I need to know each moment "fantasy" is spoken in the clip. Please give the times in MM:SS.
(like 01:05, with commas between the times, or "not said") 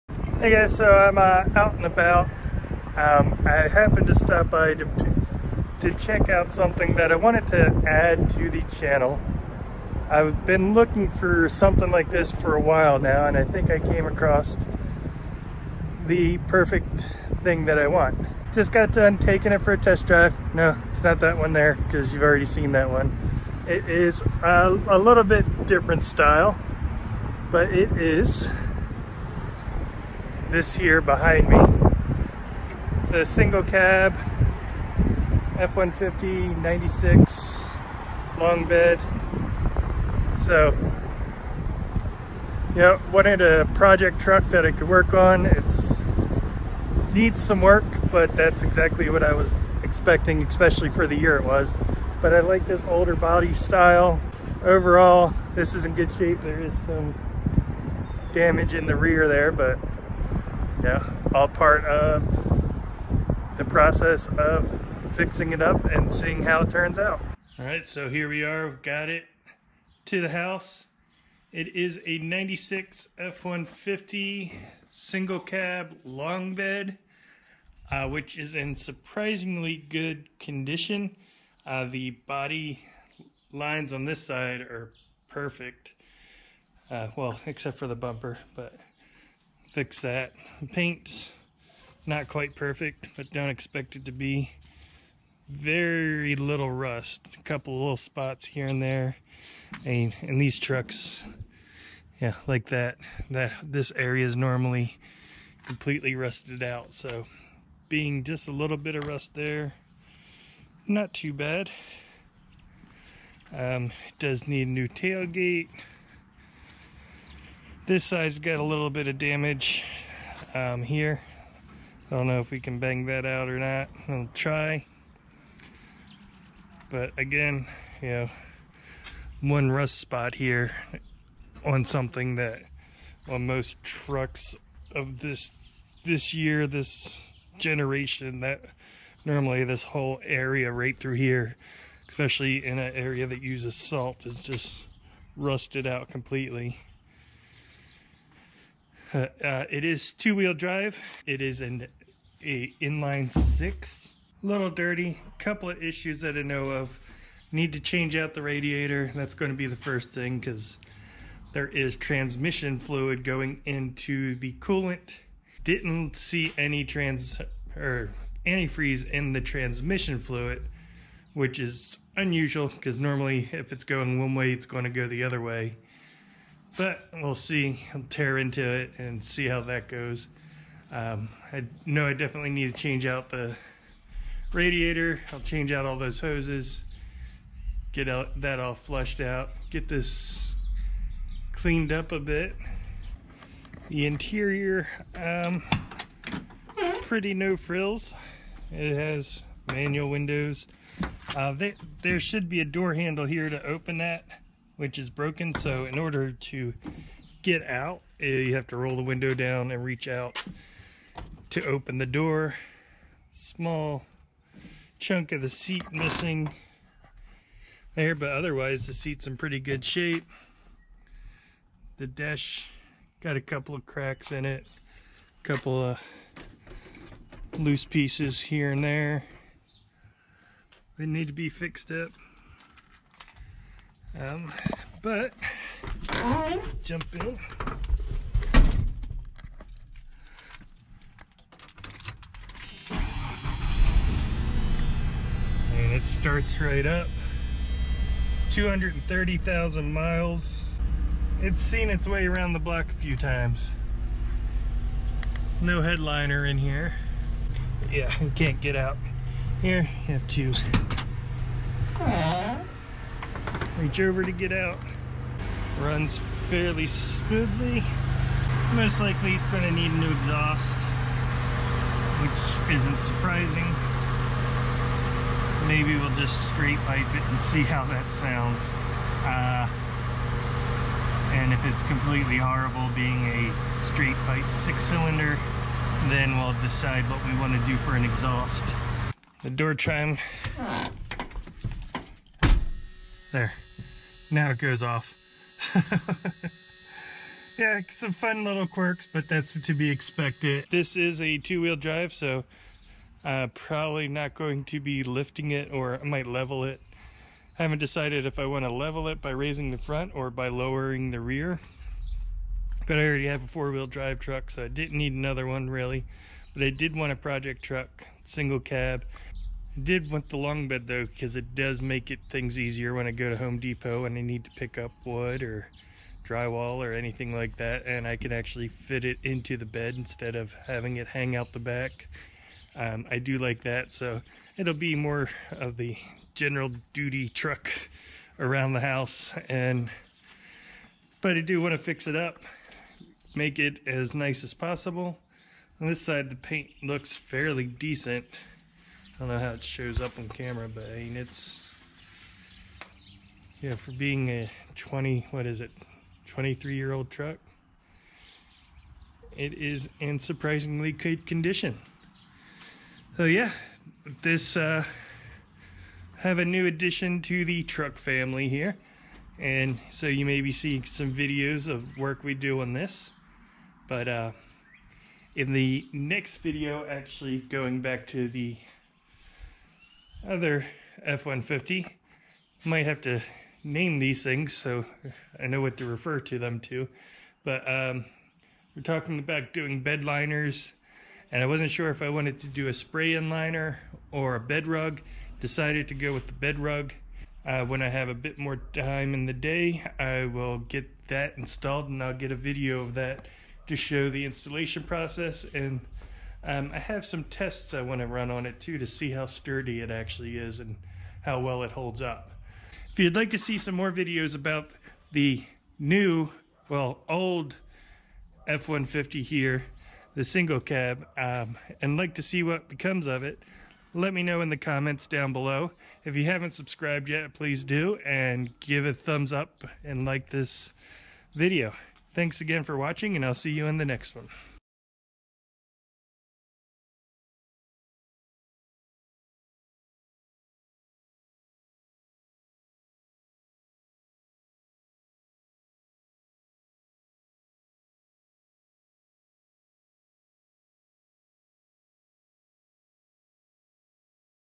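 not said.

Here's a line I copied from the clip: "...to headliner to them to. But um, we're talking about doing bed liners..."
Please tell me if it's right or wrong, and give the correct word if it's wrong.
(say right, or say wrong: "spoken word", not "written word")
wrong: "refer", not "headliner".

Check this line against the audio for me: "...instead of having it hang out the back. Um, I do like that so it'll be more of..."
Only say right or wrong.
right.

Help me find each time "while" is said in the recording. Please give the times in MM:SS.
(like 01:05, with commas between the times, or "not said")
00:12.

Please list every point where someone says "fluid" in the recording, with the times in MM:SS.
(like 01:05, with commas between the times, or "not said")
02:42, 02:50.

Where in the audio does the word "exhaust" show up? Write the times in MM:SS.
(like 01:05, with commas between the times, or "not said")
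04:30, 04:48.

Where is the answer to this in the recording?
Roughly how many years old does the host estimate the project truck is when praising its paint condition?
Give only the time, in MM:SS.
05:56.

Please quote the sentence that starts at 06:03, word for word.
So yeah, this, uh, have a new addition to the truck family here.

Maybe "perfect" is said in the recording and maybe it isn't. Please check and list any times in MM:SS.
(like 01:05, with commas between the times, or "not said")
00:16, 01:25, 01:32.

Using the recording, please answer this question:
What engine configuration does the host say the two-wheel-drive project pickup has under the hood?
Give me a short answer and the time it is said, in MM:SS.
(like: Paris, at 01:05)
inline six, at 02:32.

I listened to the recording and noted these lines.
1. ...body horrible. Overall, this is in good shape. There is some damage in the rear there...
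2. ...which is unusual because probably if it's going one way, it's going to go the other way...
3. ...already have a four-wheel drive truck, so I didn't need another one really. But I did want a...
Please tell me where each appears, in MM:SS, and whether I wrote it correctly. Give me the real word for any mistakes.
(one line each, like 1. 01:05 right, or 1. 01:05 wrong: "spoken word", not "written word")
1. 00:53 wrong: "style", not "horrible"
2. 02:51 wrong: "normally", not "probably"
3. 05:13 right.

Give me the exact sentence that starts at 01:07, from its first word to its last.
All right, so here we are, we've got it to the house.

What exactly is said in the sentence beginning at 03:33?
Small chunk of the seat missing there, but otherwise the seat's in pretty good shape.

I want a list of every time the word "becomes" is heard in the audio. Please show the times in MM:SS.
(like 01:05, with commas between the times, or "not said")
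07:02.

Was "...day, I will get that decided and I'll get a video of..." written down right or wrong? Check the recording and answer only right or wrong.
wrong.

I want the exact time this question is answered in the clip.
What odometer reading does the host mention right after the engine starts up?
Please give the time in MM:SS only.
04:08.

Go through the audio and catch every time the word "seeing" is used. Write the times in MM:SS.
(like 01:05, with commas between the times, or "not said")
01:06, 06:10.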